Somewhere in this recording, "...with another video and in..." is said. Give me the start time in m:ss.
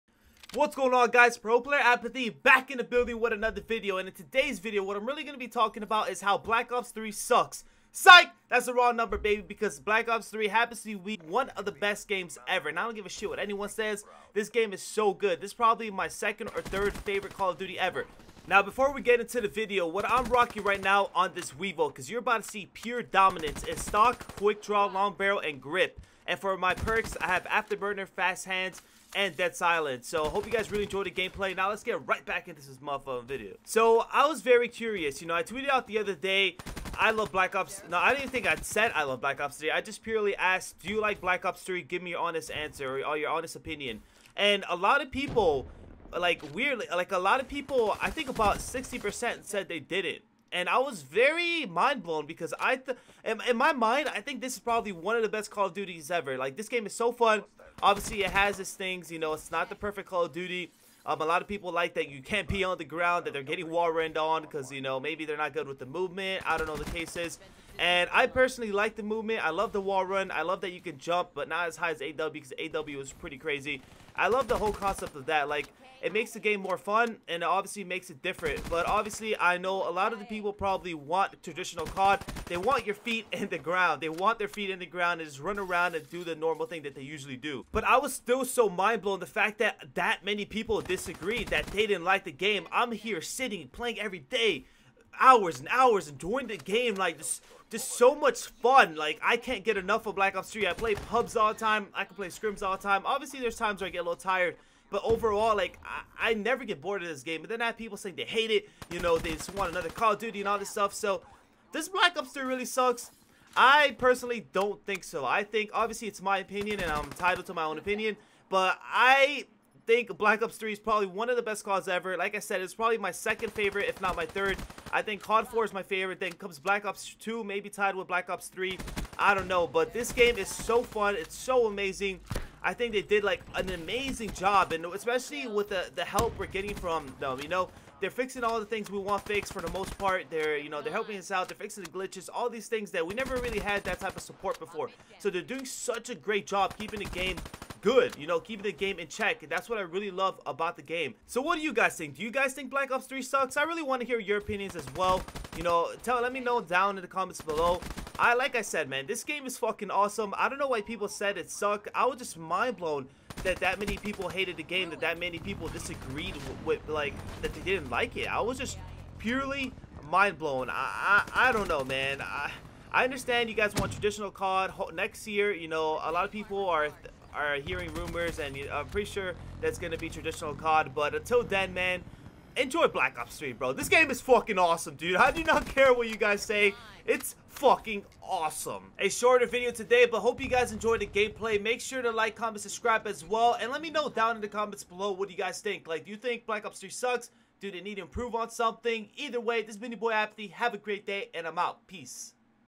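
0:03.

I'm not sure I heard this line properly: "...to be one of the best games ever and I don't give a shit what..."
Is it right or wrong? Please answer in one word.
right.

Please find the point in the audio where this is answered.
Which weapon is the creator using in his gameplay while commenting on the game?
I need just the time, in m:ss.
0:21.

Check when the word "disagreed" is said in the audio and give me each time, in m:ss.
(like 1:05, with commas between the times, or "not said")
1:30, 2:45.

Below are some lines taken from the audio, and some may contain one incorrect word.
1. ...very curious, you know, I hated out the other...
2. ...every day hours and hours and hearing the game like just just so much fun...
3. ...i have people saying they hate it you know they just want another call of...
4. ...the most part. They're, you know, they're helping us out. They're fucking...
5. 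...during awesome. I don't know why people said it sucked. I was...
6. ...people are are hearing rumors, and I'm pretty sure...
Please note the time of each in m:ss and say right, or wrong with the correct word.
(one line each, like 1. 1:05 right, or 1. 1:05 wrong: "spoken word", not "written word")
1. 0:34 wrong: "tweeted", not "hated"
2. 1:33 wrong: "during", not "hearing"
3. 1:47 right
4. 2:19 wrong: "fixing", not "fucking"
5. 2:39 wrong: "fucking", not "during"
6. 2:56 right.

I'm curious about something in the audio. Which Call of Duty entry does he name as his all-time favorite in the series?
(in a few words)
COD 4.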